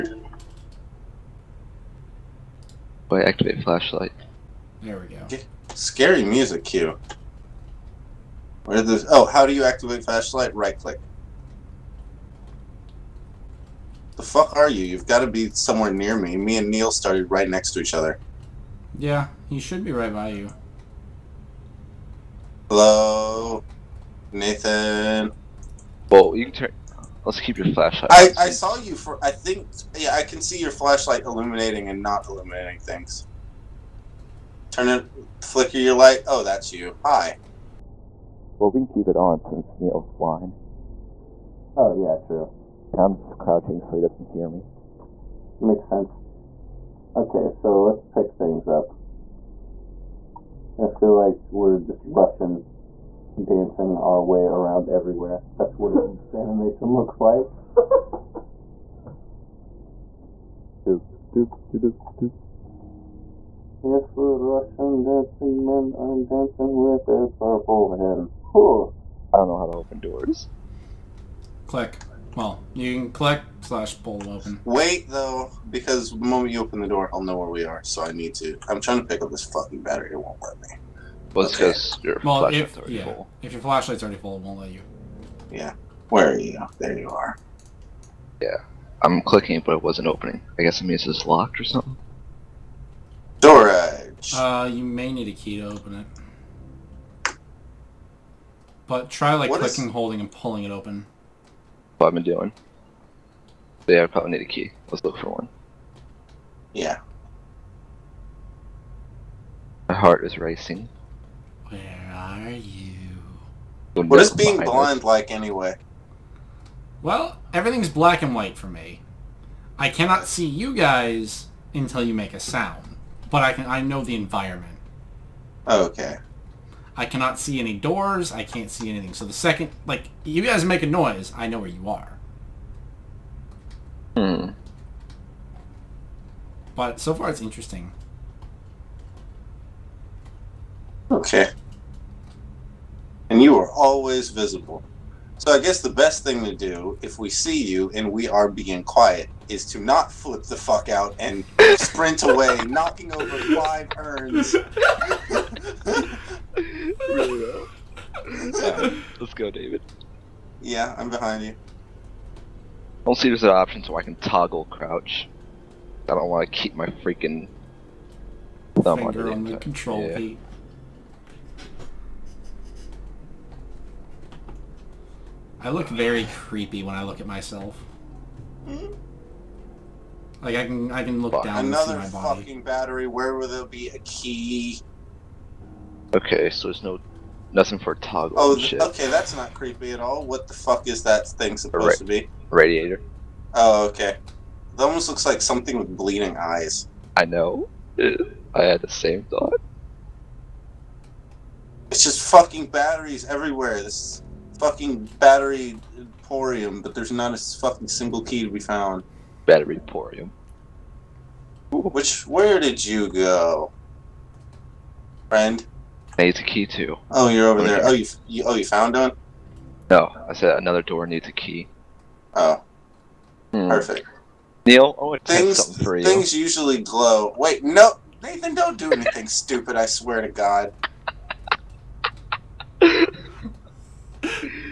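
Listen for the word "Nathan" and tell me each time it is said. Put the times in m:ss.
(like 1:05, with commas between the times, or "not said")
0:24, 3:48.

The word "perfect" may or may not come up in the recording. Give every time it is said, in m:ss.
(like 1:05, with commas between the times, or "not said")
3:43.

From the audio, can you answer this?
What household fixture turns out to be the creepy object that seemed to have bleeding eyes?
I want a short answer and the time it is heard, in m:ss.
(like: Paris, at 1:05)
Radiator, at 3:12.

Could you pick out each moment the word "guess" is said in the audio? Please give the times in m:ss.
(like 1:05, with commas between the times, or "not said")
1:30, 2:25.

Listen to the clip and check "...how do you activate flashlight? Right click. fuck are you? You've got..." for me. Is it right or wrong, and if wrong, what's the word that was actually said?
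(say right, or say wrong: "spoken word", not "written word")
right.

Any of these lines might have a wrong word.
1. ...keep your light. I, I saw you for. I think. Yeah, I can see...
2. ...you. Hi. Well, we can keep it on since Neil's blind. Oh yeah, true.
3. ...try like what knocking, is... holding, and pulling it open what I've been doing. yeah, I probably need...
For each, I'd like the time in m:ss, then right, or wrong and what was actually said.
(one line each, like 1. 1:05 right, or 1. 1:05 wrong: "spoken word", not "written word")
1. 0:27 wrong: "flashlight", not "light"
2. 0:36 right
3. 1:39 wrong: "clicking", not "knocking".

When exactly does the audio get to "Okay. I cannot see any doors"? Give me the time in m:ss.
2:05.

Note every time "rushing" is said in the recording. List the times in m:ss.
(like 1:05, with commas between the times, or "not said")
0:52.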